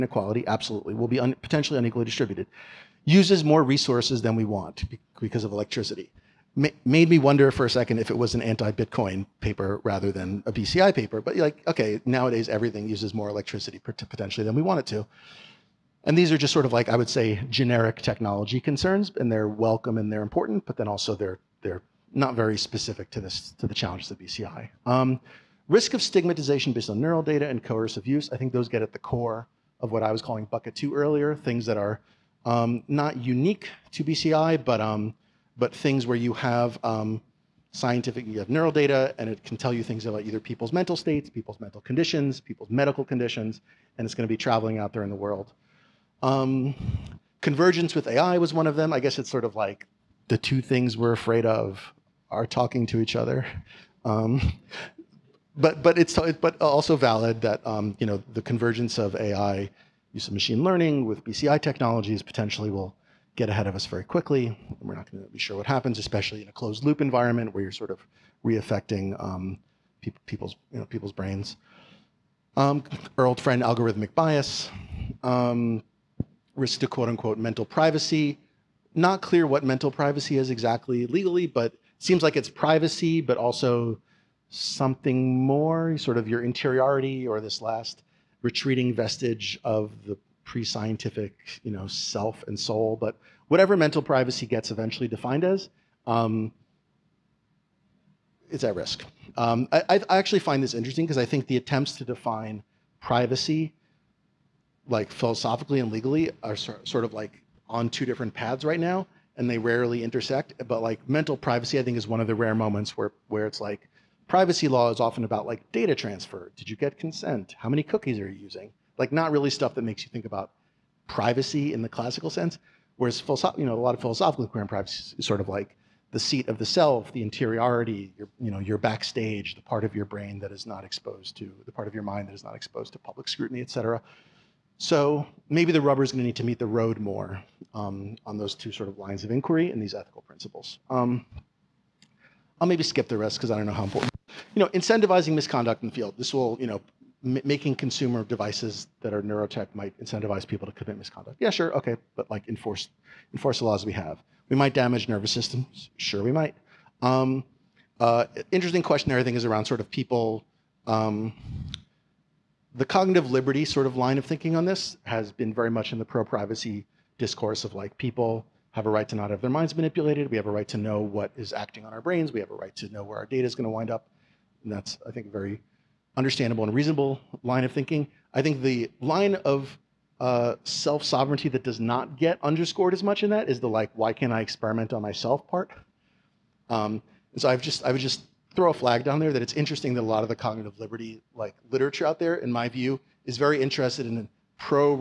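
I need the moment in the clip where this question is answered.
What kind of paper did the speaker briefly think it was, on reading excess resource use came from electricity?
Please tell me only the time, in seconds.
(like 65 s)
8 s.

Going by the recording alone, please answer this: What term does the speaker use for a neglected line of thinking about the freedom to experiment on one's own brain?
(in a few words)
self sovereignty.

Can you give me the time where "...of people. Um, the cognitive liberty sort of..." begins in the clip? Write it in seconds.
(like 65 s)
159 s.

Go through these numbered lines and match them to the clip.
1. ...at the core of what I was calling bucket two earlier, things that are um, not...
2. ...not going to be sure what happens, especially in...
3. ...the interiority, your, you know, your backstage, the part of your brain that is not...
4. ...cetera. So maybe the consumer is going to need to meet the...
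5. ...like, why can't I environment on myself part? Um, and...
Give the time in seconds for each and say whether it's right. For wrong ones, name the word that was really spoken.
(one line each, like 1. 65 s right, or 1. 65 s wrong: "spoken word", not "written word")
1. 28 s right
2. 64 s right
3. 127 s right
4. 133 s wrong: "rubber", not "consumer"
5. 183 s wrong: "experiment", not "environment".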